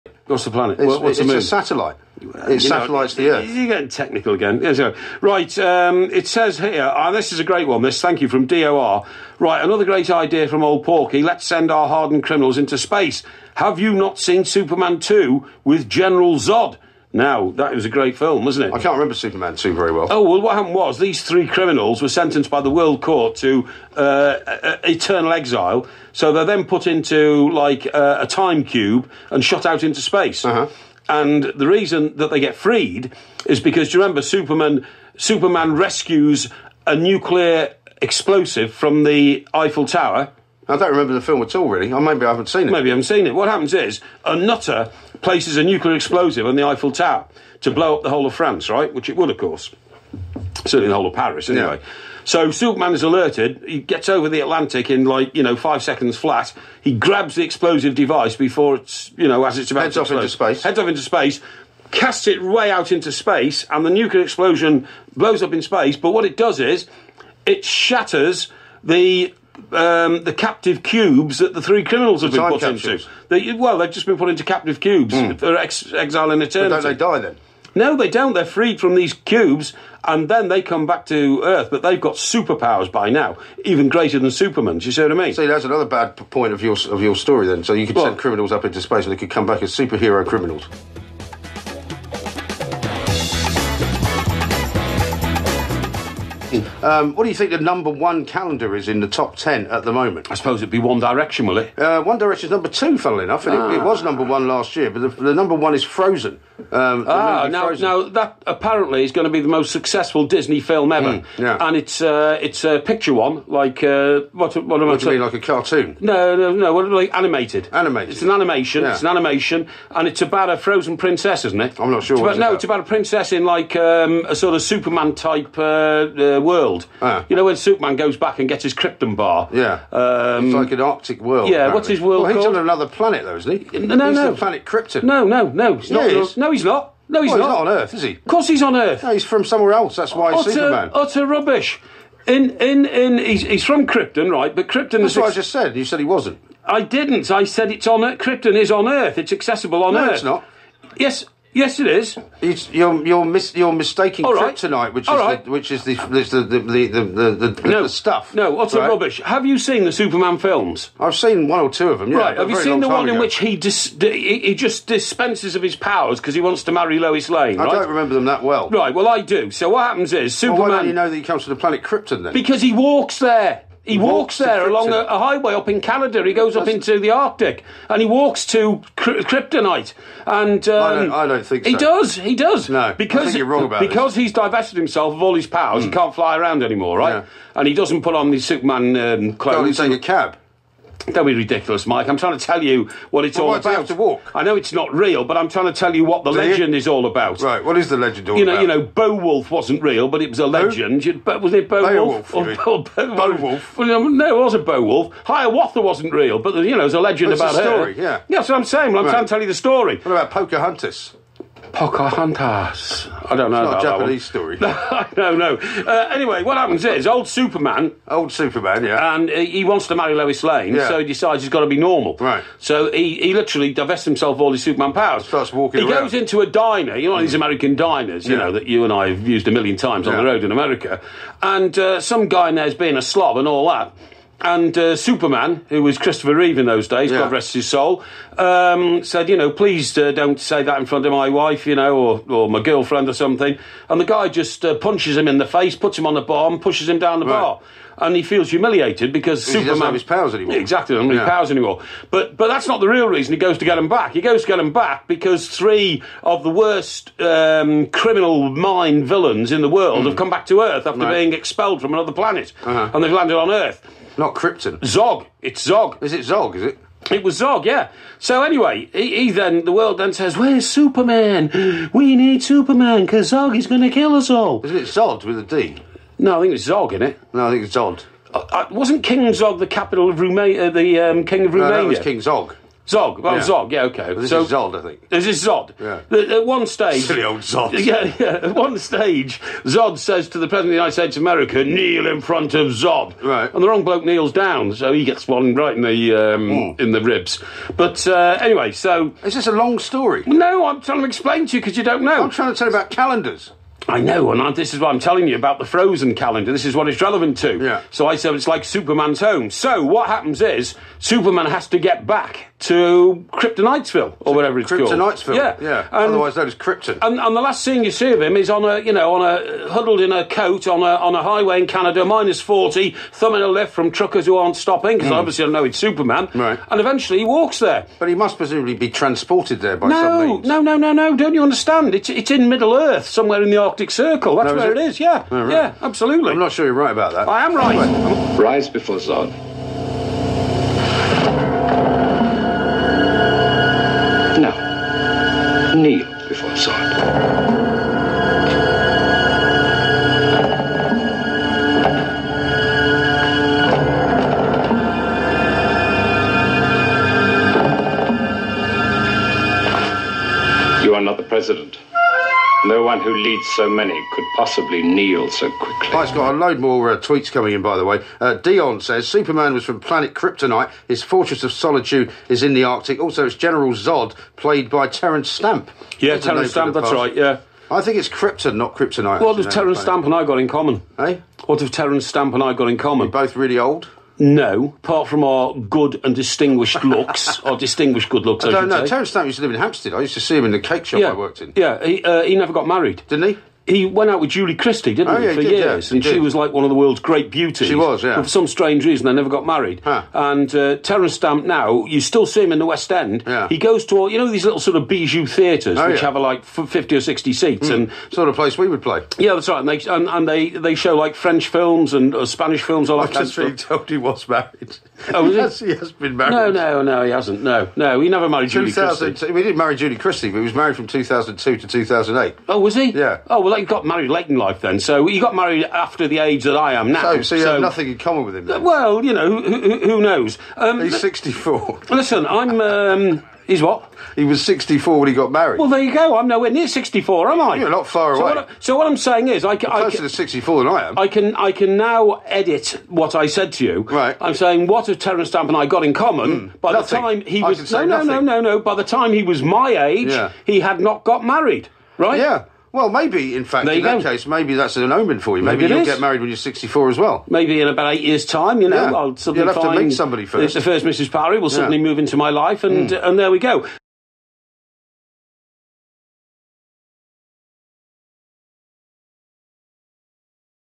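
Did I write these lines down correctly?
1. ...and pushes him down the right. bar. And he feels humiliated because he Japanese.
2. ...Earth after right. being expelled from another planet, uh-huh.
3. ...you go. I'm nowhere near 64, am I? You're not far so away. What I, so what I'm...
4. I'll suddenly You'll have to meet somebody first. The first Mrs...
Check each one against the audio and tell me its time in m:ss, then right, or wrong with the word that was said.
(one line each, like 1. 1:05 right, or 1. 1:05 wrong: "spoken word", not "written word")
1. 4:06 wrong: "Superman", not "Japanese"
2. 4:20 right
3. 7:15 right
4. 7:38 right.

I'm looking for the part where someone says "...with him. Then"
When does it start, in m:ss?
7:08.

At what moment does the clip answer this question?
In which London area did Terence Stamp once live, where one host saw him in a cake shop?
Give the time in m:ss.
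6:29.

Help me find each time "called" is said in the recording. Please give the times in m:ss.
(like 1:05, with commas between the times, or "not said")
2:12, 5:14.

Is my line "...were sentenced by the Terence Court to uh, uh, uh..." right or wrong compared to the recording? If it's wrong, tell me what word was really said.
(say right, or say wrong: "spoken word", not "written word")
wrong: "World", not "Terence".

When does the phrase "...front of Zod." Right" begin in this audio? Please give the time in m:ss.
4:52.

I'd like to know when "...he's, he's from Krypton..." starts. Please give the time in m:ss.
2:23.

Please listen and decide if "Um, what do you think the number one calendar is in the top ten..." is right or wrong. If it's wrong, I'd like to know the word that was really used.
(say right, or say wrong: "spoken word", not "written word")
right.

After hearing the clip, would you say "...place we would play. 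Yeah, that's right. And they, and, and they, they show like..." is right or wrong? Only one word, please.
right.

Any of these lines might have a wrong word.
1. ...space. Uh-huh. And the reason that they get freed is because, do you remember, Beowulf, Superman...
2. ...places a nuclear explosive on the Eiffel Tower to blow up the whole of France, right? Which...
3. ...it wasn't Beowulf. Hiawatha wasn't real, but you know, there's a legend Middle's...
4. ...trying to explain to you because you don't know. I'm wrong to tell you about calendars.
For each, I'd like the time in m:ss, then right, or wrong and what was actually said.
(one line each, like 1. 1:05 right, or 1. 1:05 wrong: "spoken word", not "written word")
1. 0:29 wrong: "Superman", not "Beowulf"
2. 0:45 right
3. 3:24 wrong: "That", not "Middle"
4. 5:00 wrong: "trying", not "wrong".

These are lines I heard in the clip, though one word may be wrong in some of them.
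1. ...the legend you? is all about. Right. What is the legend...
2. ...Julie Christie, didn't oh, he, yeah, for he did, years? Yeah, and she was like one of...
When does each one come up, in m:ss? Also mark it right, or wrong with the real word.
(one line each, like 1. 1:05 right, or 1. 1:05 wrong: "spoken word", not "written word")
1. 3:16 right
2. 6:34 right.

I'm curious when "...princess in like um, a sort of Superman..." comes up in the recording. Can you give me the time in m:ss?
2:02.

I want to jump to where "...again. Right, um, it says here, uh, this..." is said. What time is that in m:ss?
0:04.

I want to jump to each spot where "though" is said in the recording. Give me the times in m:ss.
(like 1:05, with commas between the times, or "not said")
2:13.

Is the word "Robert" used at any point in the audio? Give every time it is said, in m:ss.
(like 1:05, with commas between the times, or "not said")
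not said.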